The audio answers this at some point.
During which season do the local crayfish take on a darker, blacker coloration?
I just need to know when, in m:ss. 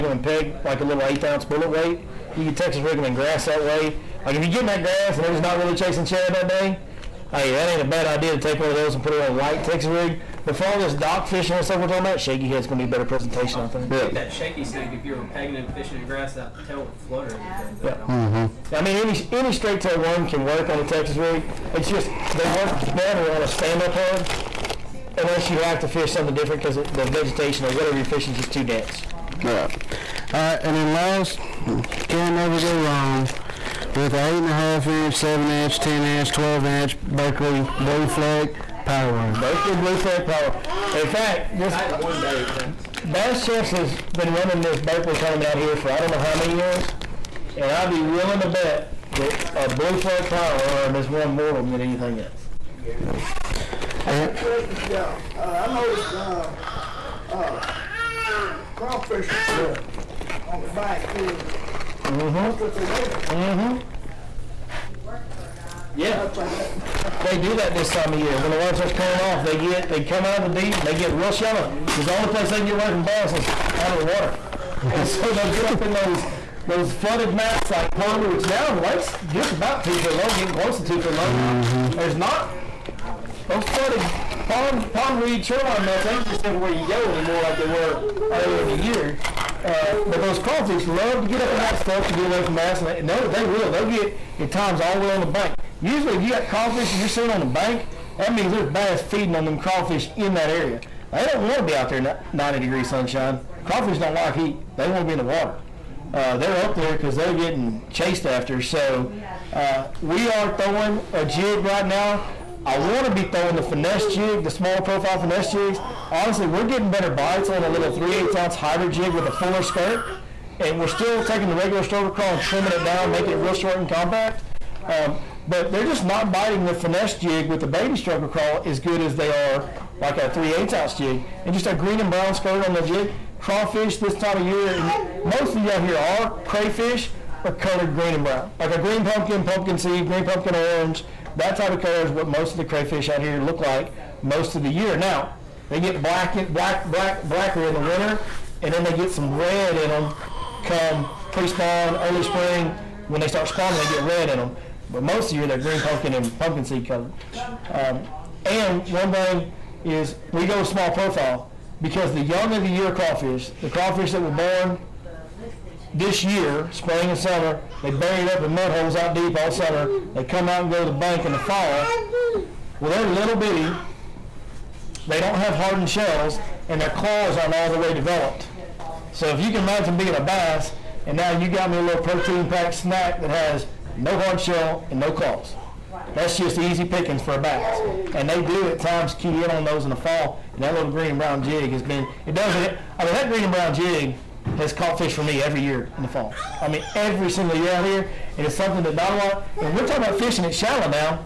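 2:27.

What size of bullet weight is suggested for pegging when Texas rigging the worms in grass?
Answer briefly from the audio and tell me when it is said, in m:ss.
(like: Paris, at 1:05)
1/8 ounce, at 0:01.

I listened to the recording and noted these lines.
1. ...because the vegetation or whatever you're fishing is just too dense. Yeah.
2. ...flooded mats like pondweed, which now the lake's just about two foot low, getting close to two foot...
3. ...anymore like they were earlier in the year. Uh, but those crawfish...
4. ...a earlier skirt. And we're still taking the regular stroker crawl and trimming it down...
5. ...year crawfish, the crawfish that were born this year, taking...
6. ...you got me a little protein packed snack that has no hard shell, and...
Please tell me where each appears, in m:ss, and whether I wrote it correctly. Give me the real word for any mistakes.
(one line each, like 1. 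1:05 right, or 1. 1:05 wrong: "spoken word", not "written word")
1. 0:26 right
2. 1:16 right
3. 1:27 right
4. 1:59 wrong: "fuller", not "earlier"
5. 2:42 wrong: "spring", not "taking"
6. 3:01 right.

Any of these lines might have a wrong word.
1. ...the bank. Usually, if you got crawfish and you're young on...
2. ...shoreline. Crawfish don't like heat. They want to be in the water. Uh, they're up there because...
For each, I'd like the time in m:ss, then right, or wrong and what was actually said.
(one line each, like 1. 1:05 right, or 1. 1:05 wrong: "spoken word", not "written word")
1. 1:35 wrong: "seeing", not "young"
2. 1:42 wrong: "sunshine", not "shoreline".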